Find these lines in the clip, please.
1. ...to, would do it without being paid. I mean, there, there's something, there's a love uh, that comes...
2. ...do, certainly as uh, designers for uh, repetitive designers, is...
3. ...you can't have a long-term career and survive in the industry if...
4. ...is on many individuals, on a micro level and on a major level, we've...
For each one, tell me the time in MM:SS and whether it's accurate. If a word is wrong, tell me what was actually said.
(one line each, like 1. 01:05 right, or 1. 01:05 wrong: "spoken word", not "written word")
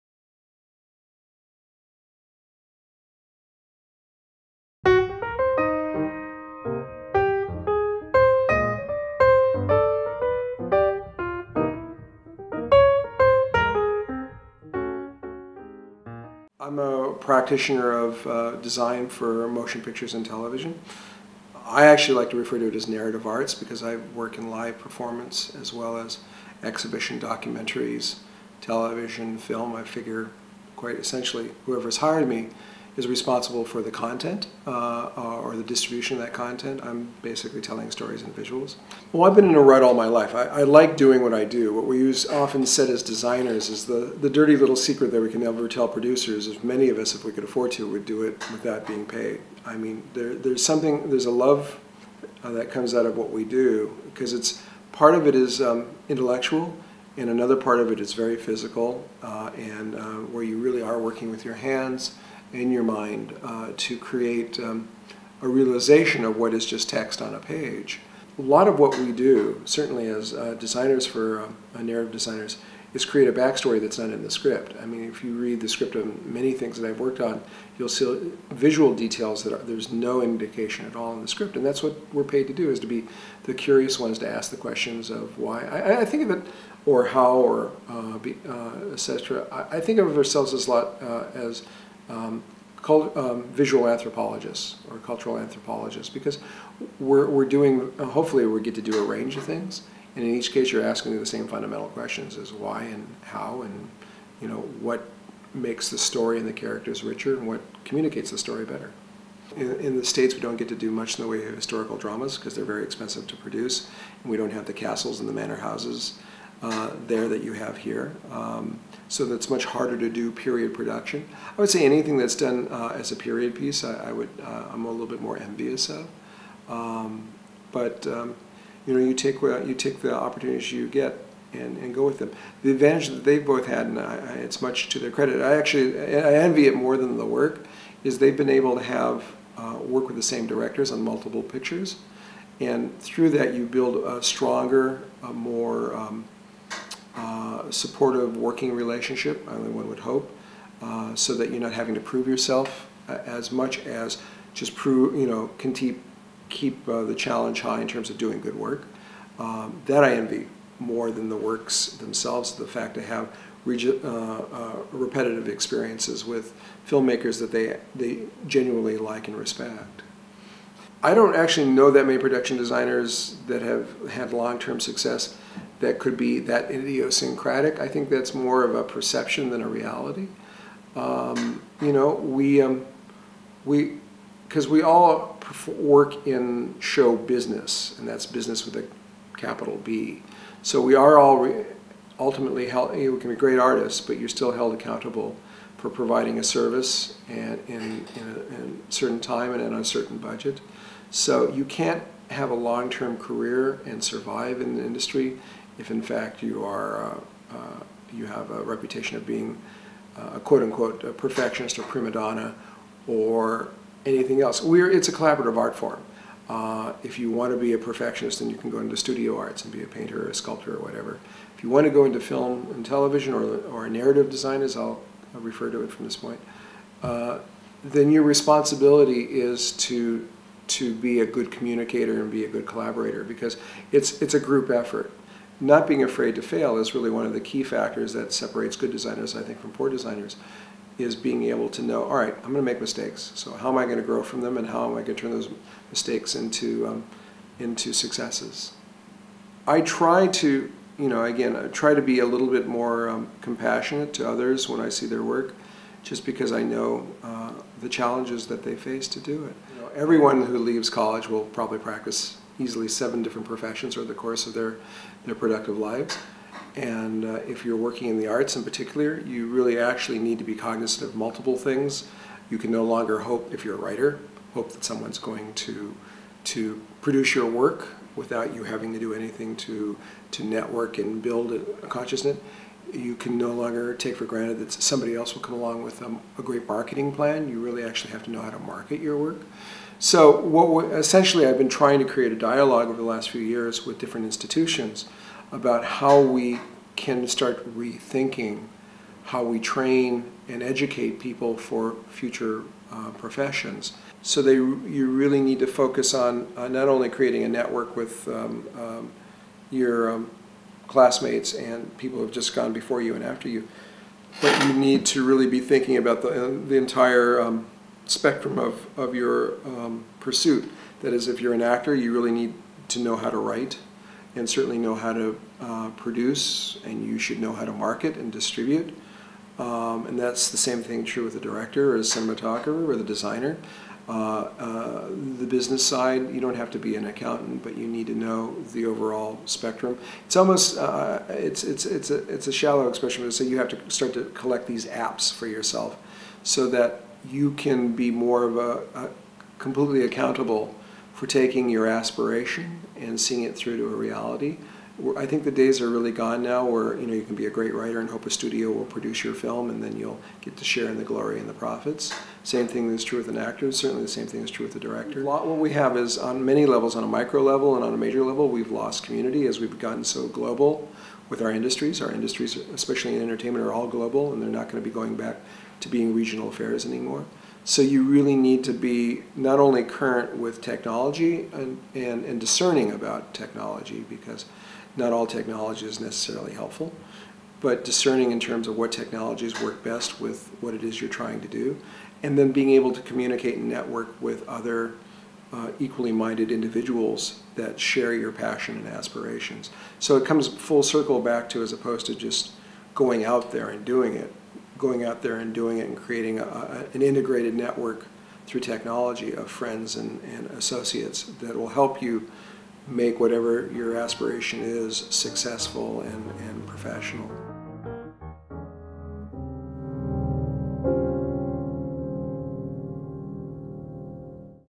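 1. 00:47 right
2. 01:09 wrong: "narrative", not "repetitive"
3. 03:21 right
4. 06:05 wrong: "levels", not "individuals".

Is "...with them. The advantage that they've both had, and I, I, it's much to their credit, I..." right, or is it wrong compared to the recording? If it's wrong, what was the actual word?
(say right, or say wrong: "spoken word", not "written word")
right.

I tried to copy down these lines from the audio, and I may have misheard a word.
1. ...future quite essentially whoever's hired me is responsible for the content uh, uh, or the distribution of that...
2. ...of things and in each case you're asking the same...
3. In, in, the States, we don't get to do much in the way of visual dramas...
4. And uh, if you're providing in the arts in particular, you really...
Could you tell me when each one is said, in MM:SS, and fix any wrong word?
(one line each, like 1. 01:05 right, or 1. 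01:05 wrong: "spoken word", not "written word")
1. 00:29 wrong: "figure", not "future"
2. 01:39 right
3. 01:49 wrong: "historical", not "visual"
4. 04:26 wrong: "working", not "providing".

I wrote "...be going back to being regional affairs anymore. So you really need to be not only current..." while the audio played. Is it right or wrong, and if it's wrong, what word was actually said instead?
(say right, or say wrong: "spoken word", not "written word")
right.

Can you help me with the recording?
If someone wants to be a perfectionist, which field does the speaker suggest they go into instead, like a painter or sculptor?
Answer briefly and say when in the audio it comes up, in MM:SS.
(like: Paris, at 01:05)
studio arts, at 03:38.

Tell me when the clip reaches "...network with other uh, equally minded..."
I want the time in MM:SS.
06:33.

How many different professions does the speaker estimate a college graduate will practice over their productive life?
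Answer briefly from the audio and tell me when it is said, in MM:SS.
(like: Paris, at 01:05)
7, at 04:22.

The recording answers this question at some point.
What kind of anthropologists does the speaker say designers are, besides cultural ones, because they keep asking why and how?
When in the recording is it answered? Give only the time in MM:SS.
01:33.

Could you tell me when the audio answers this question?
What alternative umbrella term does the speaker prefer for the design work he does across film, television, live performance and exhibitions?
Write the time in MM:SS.
00:22.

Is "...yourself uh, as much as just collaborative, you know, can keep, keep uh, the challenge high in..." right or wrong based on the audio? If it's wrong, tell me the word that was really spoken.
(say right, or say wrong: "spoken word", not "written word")
wrong: "prove", not "collaborative".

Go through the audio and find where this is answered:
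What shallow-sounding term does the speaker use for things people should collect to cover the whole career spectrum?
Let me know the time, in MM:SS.
05:44.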